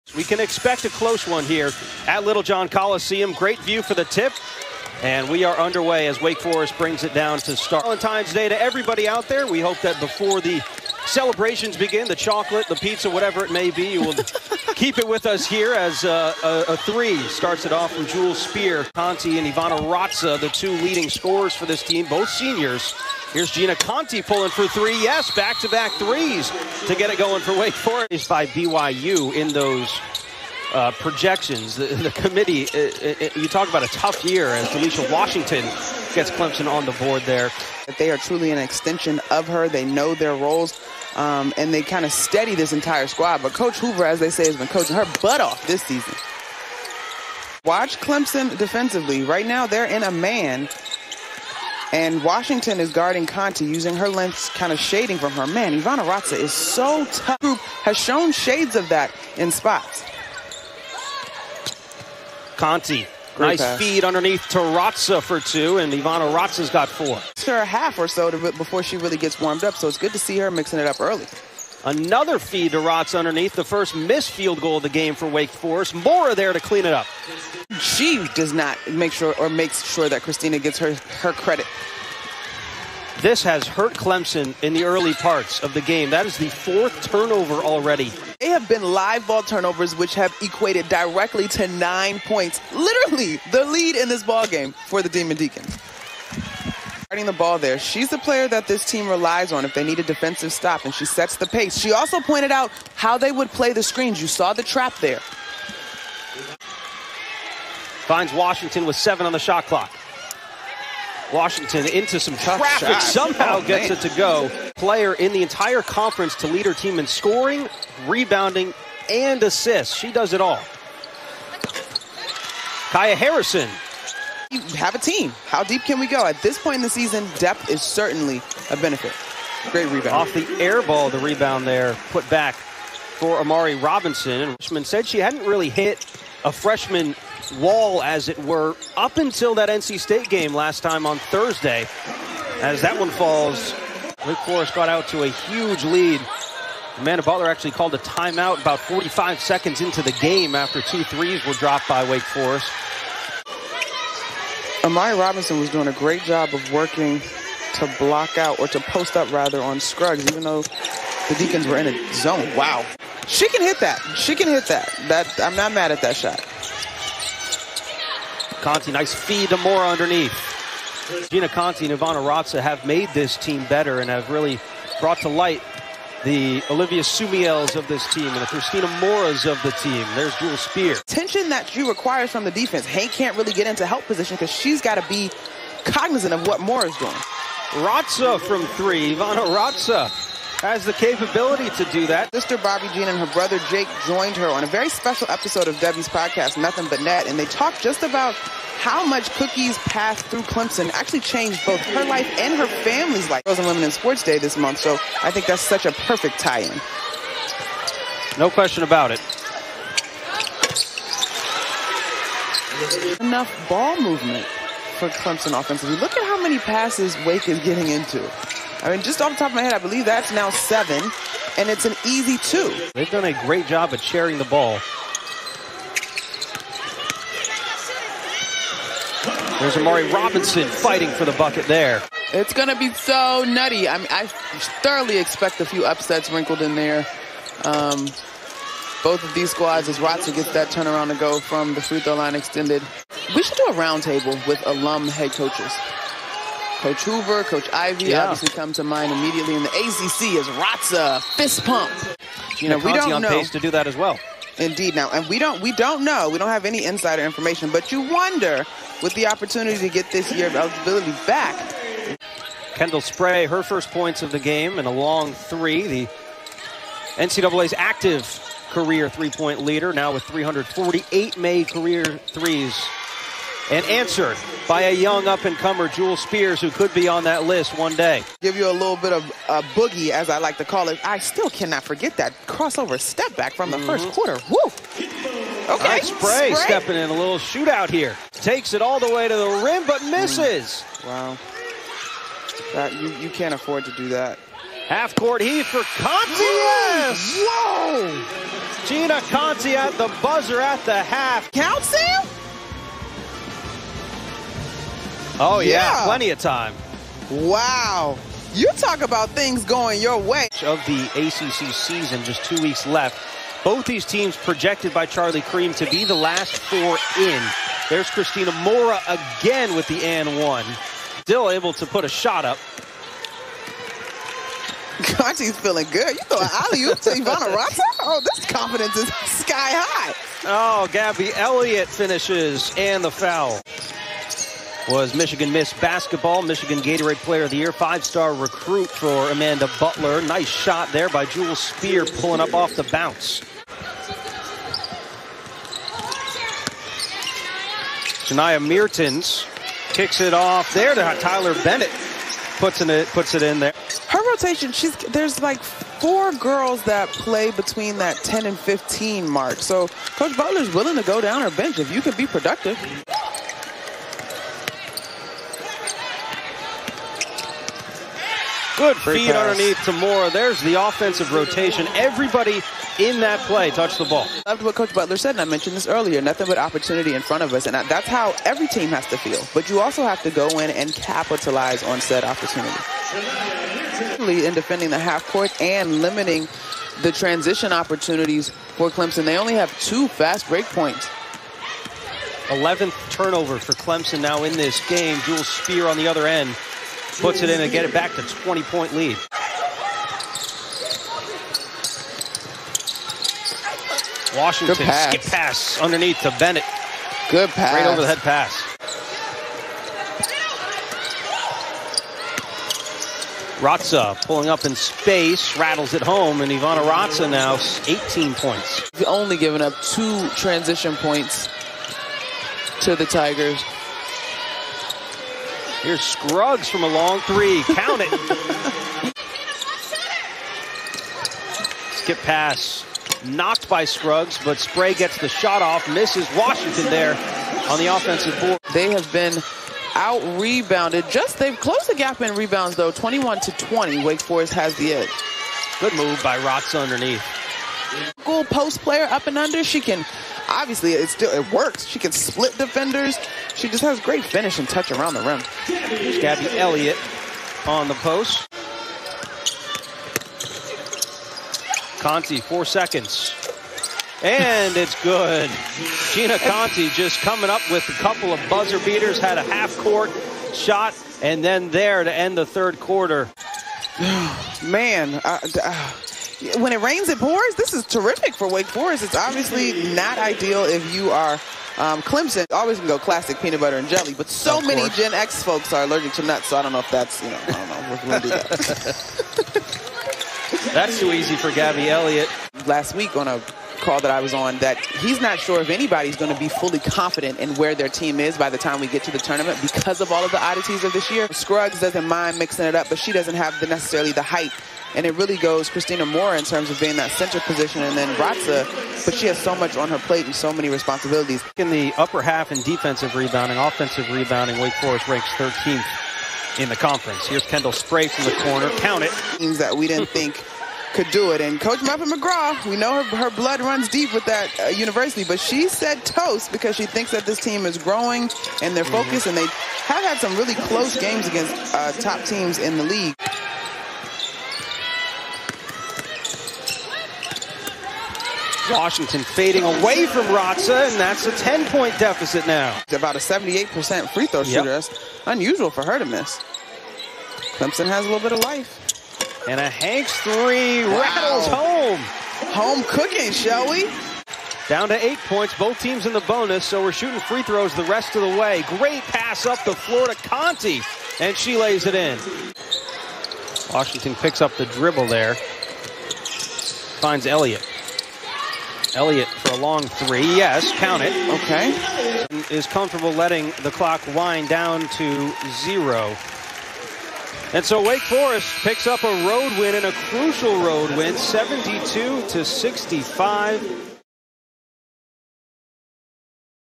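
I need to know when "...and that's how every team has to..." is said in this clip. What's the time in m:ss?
6:17.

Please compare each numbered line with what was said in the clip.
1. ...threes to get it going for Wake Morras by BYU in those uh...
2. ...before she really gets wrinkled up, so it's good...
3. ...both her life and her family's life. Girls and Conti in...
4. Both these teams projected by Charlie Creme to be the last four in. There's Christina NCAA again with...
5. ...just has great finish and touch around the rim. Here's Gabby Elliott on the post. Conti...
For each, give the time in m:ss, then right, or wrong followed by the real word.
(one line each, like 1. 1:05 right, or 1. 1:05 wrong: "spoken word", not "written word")
1. 0:25 wrong: "Forest", not "Morras"
2. 1:08 wrong: "warmed", not "wrinkled"
3. 3:21 wrong: "Women", not "Conti"
4. 5:13 wrong: "Morra", not "NCAA"
5. 7:33 right.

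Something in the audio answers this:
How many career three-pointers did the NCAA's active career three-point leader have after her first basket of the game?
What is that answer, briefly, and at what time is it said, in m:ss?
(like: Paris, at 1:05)
348, at 4:30.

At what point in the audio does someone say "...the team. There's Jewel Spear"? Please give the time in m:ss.
2:59.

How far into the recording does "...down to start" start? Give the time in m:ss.
0:07.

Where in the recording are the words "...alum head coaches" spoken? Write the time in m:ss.
4:04.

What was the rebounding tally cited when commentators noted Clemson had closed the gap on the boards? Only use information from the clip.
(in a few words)
21 to 20.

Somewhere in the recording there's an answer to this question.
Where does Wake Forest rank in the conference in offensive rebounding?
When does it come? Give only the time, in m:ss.
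8:35.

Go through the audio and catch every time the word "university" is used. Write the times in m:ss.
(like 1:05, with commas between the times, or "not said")
8:44.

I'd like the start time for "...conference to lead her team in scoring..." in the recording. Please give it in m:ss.
1:55.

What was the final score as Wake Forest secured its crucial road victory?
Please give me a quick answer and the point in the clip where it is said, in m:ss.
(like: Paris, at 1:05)
72 to 65, at 9:41.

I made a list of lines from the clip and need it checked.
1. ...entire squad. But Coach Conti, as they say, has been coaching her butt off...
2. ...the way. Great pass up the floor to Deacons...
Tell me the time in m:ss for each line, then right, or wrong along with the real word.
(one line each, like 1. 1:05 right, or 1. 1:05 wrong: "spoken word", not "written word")
1. 0:42 wrong: "Hoover", not "Conti"
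2. 9:18 wrong: "Conti", not "Deacons".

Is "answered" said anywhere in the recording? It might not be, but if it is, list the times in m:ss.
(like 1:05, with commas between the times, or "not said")
4:33.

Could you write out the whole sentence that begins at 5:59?
So Coach Butler's willing to go down her bench if you can be productive.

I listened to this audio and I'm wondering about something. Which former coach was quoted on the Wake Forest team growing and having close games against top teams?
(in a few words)
Muffet McGraw.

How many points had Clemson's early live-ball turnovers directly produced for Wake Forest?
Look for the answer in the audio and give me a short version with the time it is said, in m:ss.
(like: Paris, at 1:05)
9, at 1:31.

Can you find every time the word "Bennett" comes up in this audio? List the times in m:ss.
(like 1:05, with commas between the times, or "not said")
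5:51, 6:46.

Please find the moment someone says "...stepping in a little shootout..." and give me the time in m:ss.
4:46.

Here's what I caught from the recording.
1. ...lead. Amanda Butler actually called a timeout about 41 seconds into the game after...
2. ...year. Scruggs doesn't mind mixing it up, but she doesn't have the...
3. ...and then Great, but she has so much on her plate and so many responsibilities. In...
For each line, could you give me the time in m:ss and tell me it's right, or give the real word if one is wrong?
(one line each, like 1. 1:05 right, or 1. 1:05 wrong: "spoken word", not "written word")
1. 2:25 wrong: "45", not "41"
2. 8:21 right
3. 8:27 wrong: "Raca", not "Great".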